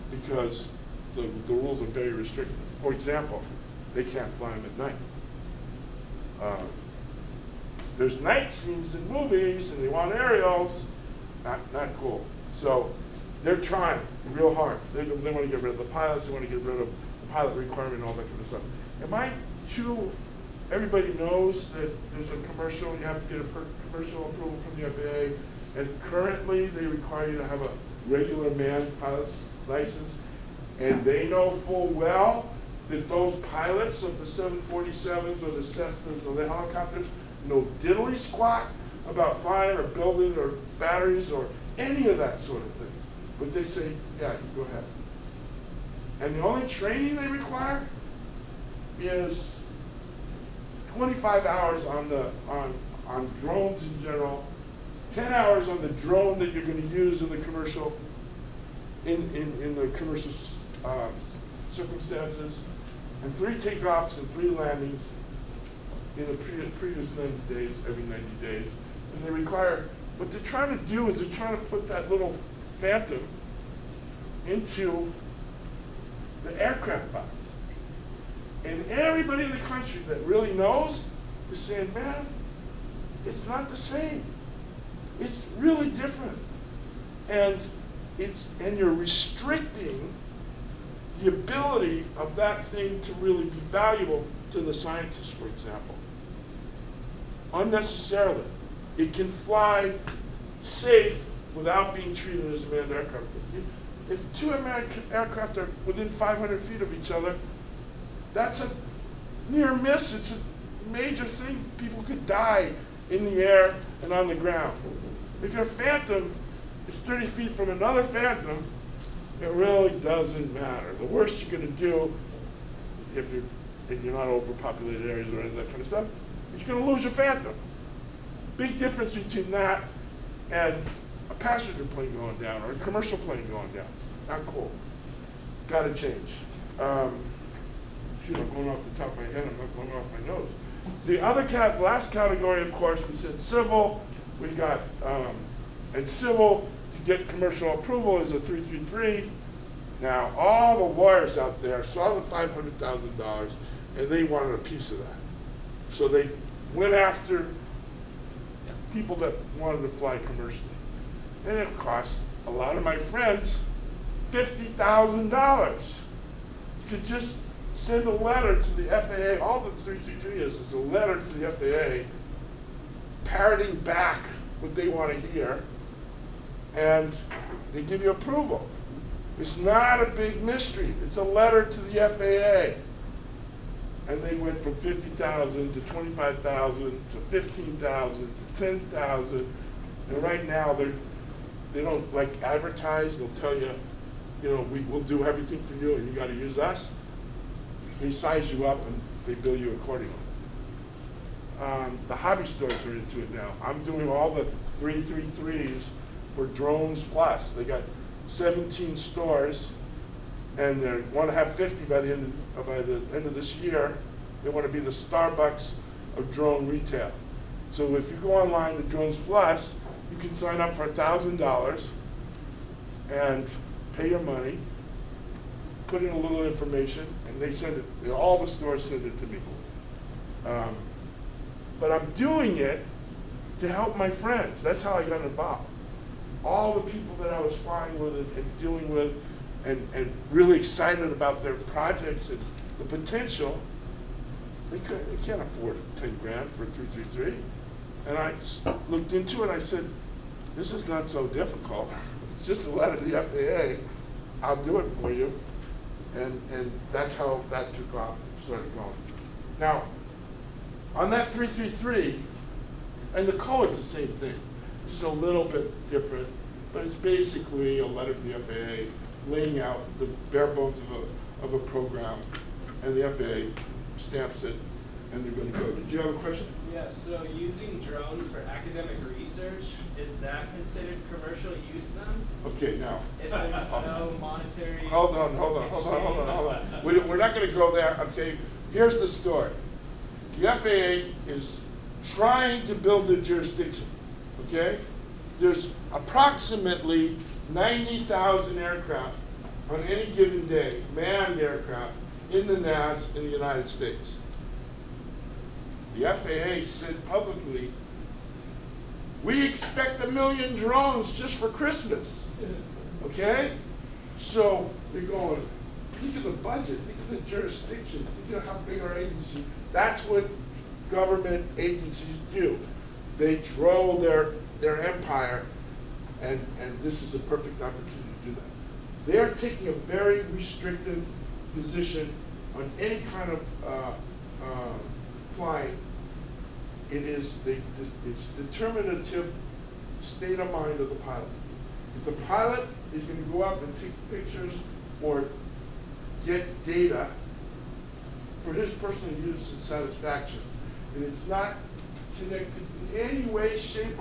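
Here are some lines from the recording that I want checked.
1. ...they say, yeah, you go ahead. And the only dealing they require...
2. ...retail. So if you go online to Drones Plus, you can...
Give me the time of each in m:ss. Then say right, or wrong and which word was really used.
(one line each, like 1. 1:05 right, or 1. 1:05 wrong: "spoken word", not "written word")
1. 0:43 wrong: "training", not "dealing"
2. 3:36 right.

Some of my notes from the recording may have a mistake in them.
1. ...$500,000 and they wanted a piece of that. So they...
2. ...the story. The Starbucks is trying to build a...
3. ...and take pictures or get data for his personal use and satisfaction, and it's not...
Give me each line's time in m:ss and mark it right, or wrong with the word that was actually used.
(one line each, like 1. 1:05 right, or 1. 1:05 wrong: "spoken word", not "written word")
1. 2:32 right
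2. 4:48 wrong: "FAA", not "Starbucks"
3. 5:43 right.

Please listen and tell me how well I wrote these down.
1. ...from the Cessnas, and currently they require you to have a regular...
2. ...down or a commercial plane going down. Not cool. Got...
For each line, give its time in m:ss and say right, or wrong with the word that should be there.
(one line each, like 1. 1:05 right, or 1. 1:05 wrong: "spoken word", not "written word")
1. 0:24 wrong: "FAA", not "Cessnas"
2. 2:12 right.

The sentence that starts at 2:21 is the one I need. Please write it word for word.
The other cat, last category, of course, we said civil.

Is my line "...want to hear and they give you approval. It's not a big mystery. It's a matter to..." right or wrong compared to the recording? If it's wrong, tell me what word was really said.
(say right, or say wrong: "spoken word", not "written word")
wrong: "letter", not "matter".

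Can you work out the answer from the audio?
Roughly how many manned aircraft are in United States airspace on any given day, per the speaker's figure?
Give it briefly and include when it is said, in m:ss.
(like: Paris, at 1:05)
90,000, at 4:57.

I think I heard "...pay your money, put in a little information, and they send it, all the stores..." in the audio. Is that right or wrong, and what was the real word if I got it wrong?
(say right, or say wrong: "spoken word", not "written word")
right.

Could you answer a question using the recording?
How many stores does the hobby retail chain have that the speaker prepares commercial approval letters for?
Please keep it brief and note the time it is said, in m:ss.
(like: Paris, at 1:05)
17, at 3:28.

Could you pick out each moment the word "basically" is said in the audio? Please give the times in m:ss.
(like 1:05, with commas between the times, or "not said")
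4:26.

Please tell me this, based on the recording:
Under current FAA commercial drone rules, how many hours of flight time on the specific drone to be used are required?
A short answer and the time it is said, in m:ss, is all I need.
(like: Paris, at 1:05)
10 hours, at 0:55.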